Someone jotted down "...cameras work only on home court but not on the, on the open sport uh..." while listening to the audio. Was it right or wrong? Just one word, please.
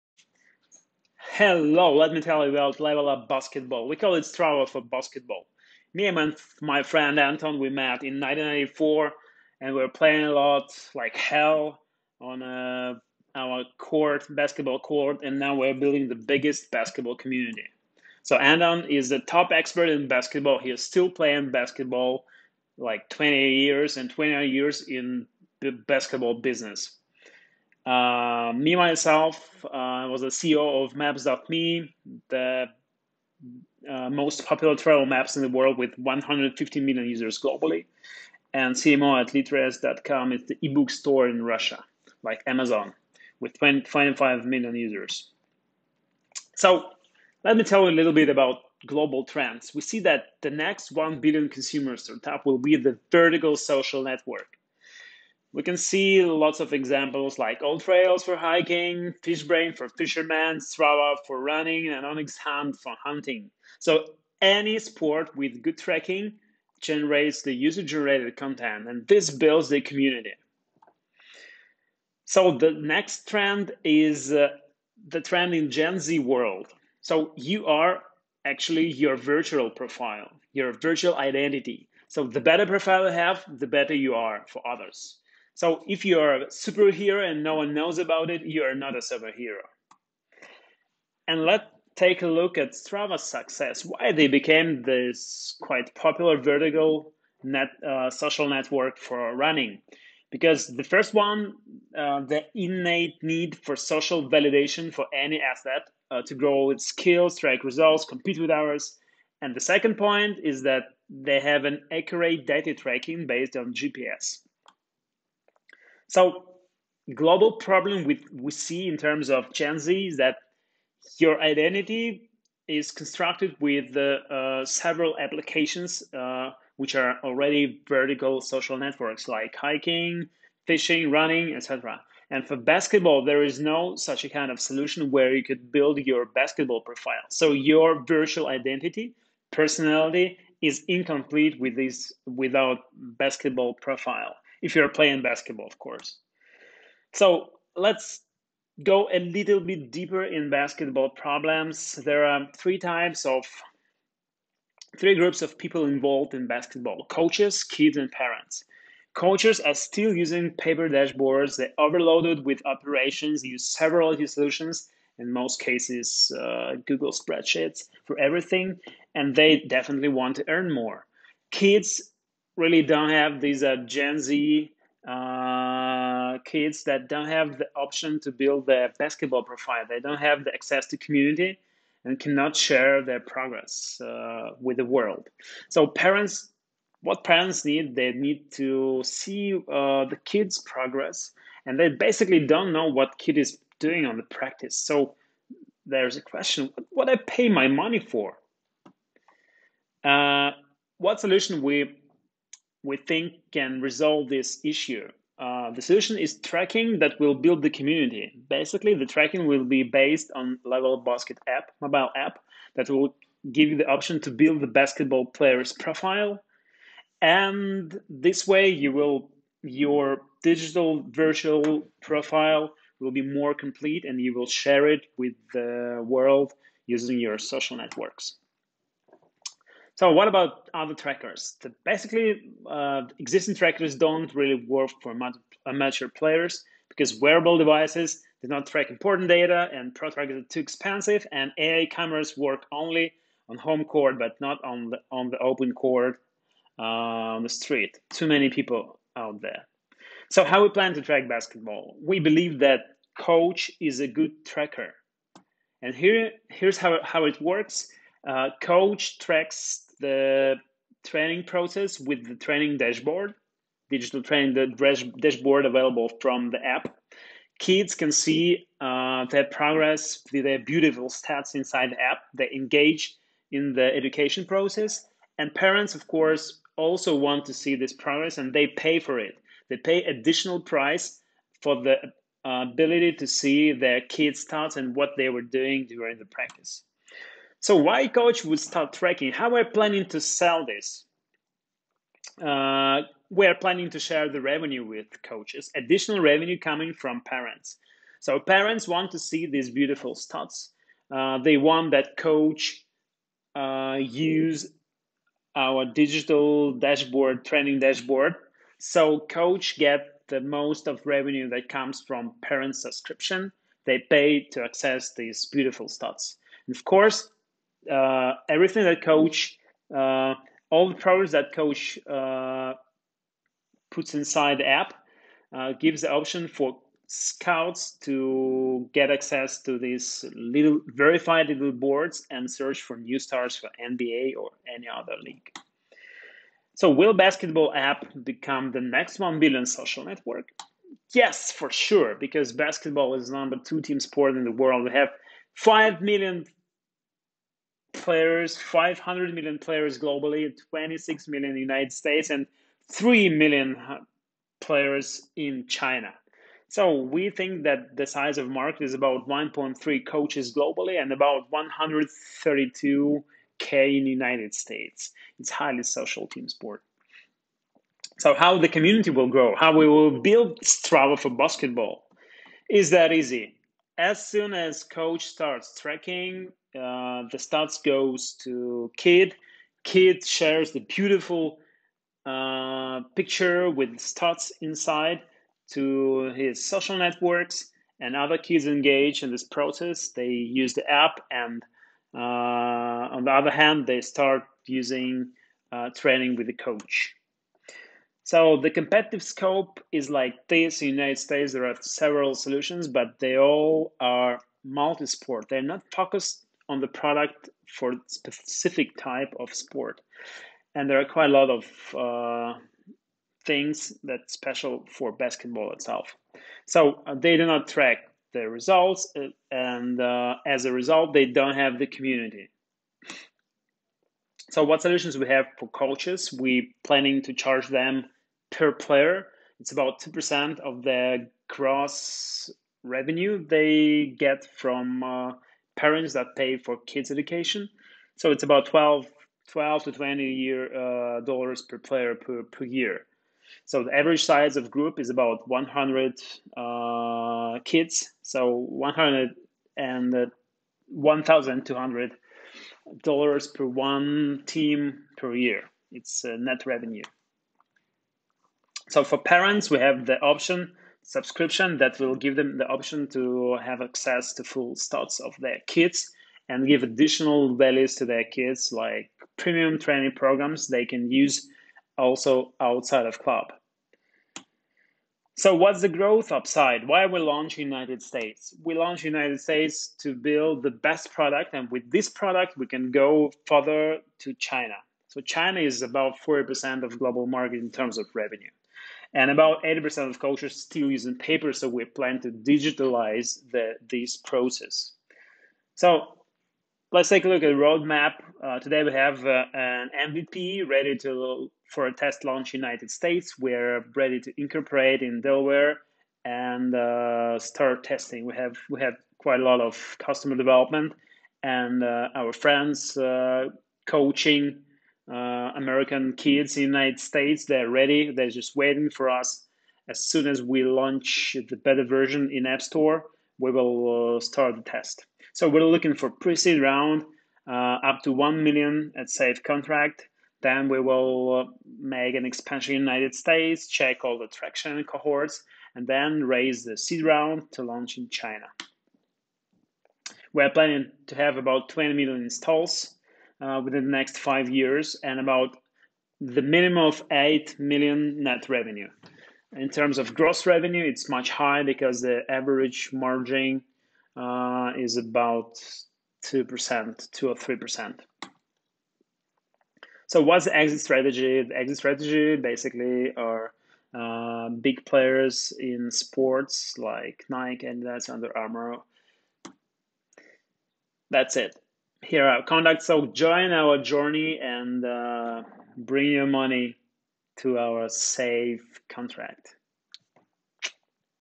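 wrong.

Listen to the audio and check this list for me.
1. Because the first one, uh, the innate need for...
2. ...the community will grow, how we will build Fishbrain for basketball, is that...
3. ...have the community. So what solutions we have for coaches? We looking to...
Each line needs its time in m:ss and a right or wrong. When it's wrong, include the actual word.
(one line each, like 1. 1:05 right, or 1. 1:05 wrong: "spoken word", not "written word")
1. 1:40 right
2. 6:08 wrong: "Strava", not "Fishbrain"
3. 7:01 wrong: "planning", not "looking".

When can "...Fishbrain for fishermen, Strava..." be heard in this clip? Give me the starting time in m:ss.
0:59.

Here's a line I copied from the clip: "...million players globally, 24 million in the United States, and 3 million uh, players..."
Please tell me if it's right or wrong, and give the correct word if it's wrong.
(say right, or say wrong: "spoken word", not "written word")
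wrong: "26", not "24".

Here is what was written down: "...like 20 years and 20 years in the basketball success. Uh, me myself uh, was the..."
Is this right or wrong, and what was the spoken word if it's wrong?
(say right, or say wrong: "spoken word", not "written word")
wrong: "business", not "success".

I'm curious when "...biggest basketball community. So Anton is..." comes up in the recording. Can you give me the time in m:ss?
0:16.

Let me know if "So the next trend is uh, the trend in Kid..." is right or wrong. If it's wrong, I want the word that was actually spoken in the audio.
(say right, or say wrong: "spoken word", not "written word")
wrong: "Gen", not "Kid".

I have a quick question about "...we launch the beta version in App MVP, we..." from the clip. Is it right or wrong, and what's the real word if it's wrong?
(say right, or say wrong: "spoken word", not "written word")
wrong: "Store", not "MVP".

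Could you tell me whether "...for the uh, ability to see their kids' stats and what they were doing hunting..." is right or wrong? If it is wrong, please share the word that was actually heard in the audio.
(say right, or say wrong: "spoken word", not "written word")
wrong: "during", not "hunting".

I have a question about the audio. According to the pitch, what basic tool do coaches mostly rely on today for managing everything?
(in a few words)
Google spreadsheets.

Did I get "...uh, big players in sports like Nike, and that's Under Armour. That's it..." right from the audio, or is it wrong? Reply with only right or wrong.
right.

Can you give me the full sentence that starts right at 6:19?
Kid shares the beautiful uh, picture with stats inside to his social networks, and other kids engage in this process.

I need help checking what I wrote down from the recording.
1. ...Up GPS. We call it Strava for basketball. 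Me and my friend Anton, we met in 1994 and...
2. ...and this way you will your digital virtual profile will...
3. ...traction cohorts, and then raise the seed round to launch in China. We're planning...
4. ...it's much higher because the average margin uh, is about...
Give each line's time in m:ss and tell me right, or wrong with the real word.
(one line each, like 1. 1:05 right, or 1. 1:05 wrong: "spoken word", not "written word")
1. 0:03 wrong: "Basketball", not "GPS"
2. 3:37 right
3. 8:54 right
4. 9:10 right.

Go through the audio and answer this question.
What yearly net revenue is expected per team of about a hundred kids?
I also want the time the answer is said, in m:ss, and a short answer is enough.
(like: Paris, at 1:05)
1,200 dollars, at 7:30.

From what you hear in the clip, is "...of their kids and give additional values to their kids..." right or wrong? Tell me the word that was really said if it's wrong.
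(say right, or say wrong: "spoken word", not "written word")
right.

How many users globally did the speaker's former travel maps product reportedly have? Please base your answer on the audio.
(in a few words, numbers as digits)
150 million.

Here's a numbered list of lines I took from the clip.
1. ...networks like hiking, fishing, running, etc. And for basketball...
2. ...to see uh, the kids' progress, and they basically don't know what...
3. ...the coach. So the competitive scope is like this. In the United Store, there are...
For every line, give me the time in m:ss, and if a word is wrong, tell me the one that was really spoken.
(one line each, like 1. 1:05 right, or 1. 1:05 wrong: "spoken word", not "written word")
1. 2:08 right
2. 3:08 right
3. 6:36 wrong: "States", not "Store".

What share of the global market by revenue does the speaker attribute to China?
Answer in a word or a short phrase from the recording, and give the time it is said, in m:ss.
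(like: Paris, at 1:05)
40%, at 8:06.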